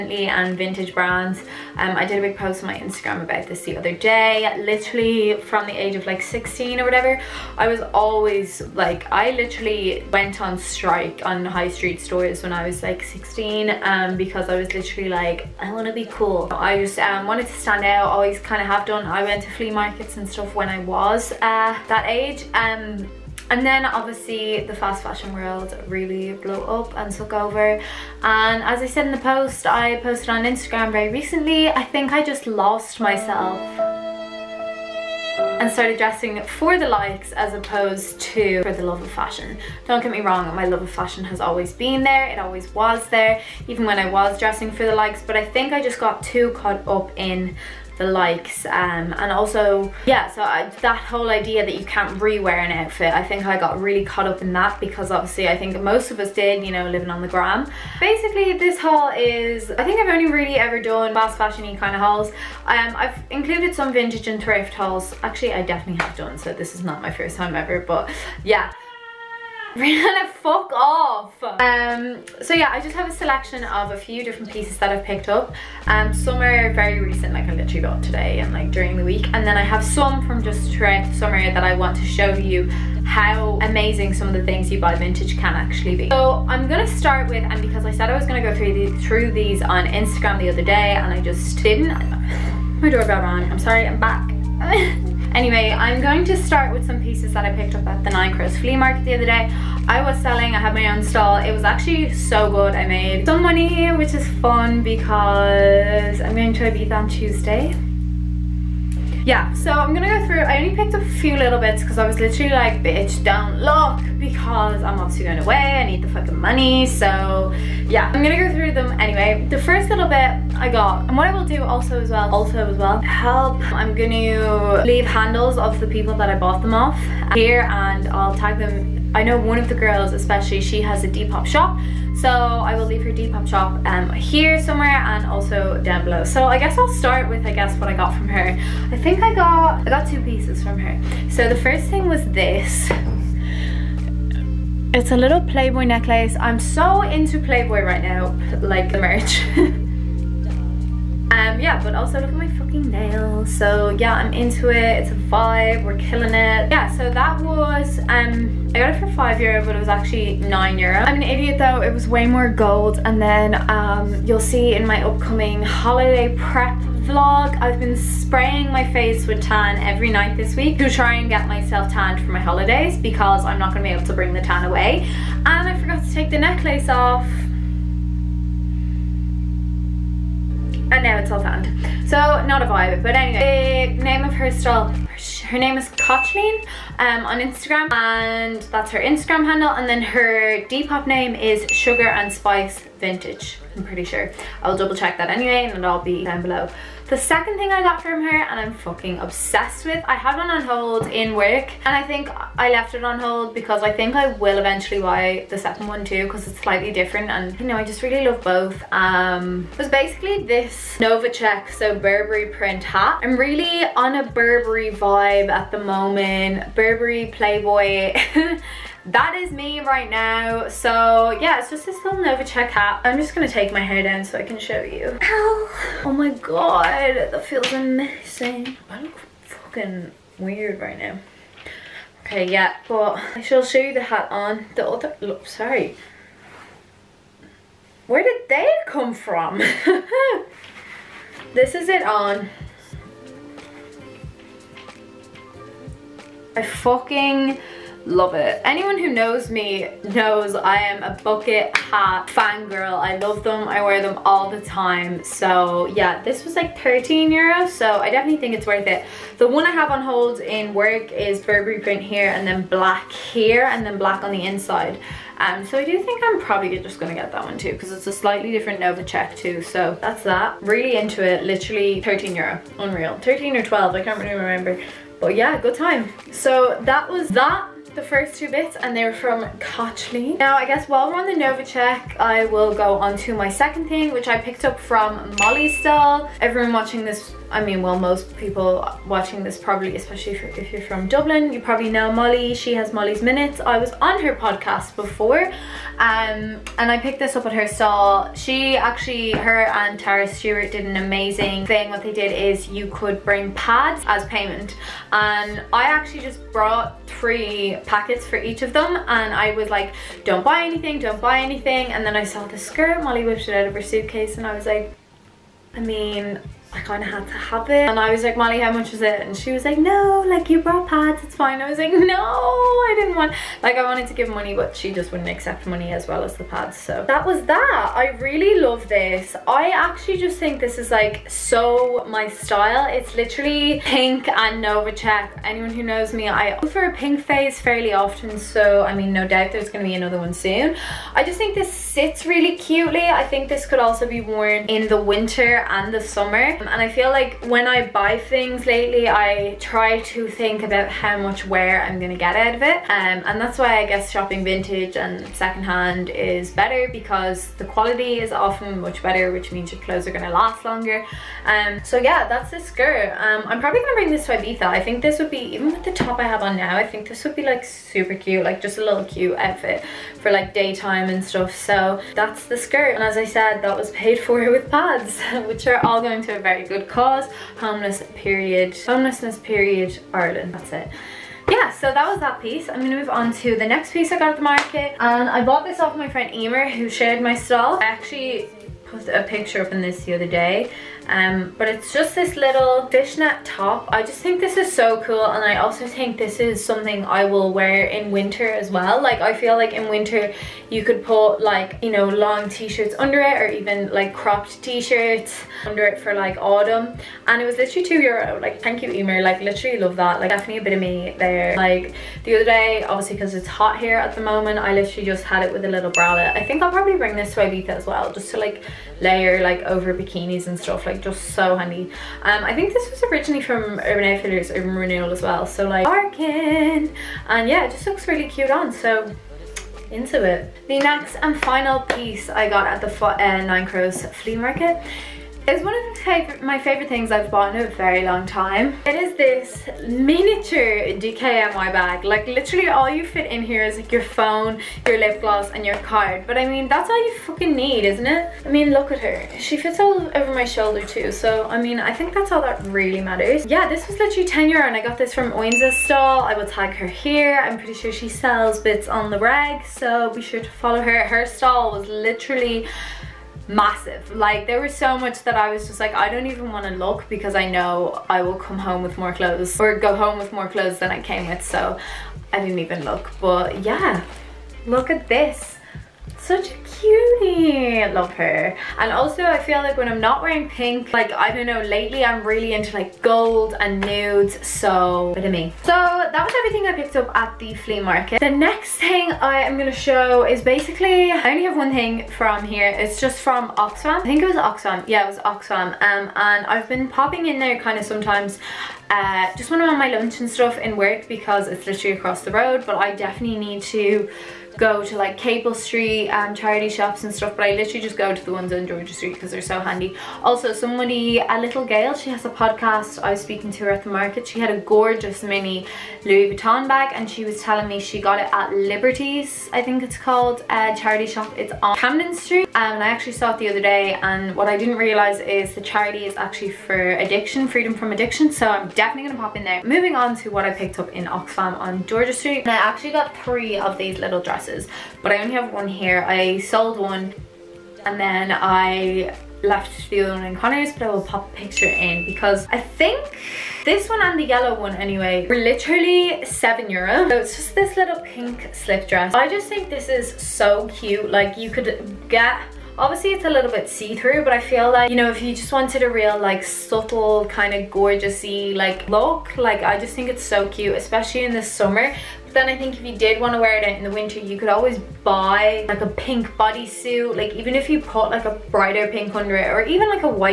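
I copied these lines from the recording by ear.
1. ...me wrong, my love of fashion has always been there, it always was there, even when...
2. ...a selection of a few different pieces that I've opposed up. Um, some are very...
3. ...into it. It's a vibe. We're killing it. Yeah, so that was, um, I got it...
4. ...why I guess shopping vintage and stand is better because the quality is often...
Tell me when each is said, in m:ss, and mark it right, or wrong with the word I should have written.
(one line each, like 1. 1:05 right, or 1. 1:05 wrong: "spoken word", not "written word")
1. 0:40 right
2. 1:13 wrong: "picked", not "opposed"
3. 2:34 right
4. 5:53 wrong: "secondhand", not "stand".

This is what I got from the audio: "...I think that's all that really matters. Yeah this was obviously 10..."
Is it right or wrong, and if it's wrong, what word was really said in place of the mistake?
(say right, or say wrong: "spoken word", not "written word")
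wrong: "literally", not "obviously".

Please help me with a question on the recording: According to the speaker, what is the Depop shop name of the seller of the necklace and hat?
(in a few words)
Sugar and Spice Vintage.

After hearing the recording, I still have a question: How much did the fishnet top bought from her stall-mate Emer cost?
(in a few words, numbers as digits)
2 euro.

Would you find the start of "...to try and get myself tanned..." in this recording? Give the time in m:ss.
2:50.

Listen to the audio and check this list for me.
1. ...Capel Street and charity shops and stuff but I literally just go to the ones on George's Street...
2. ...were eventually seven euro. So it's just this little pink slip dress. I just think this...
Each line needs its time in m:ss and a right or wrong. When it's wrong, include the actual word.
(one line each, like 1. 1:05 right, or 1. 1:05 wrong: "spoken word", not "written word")
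1. 8:25 right
2. 9:05 wrong: "literally", not "eventually".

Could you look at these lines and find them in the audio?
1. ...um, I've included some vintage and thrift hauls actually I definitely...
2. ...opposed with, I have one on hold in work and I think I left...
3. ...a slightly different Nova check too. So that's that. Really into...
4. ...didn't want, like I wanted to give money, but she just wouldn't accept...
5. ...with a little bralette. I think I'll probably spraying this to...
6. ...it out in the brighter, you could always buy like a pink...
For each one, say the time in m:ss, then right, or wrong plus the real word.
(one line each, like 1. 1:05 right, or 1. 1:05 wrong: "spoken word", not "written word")
1. 1:02 right
2. 3:19 wrong: "obsessed", not "opposed"
3. 4:28 right
4. 5:22 right
5. 6:55 wrong: "bring", not "spraying"
6. 9:23 wrong: "winter", not "brighter".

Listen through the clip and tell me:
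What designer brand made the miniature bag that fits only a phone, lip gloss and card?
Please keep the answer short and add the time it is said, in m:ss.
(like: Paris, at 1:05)
DKNY, at 7:20.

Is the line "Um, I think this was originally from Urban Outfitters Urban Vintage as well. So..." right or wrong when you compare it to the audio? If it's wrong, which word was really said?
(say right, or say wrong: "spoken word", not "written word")
wrong: "Renewal", not "Vintage".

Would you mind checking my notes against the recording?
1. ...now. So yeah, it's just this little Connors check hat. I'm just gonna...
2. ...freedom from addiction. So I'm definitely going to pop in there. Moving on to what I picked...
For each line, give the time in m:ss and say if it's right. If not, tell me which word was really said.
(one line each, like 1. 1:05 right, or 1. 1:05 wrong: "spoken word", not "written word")
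1. 3:40 wrong: "Nova", not "Connors"
2. 8:47 right.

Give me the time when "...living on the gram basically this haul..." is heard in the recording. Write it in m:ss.
0:56.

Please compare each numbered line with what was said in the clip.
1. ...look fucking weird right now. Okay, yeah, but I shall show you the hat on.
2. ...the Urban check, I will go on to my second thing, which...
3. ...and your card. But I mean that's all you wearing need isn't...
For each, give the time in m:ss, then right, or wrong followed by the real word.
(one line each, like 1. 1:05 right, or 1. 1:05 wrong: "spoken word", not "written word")
1. 3:49 right
2. 4:41 wrong: "Nova", not "Urban"
3. 7:25 wrong: "fucking", not "wearing".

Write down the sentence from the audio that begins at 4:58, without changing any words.
She actually, her and Tara Stewart did an amazing thing.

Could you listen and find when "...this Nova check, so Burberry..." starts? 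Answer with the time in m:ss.
3:30.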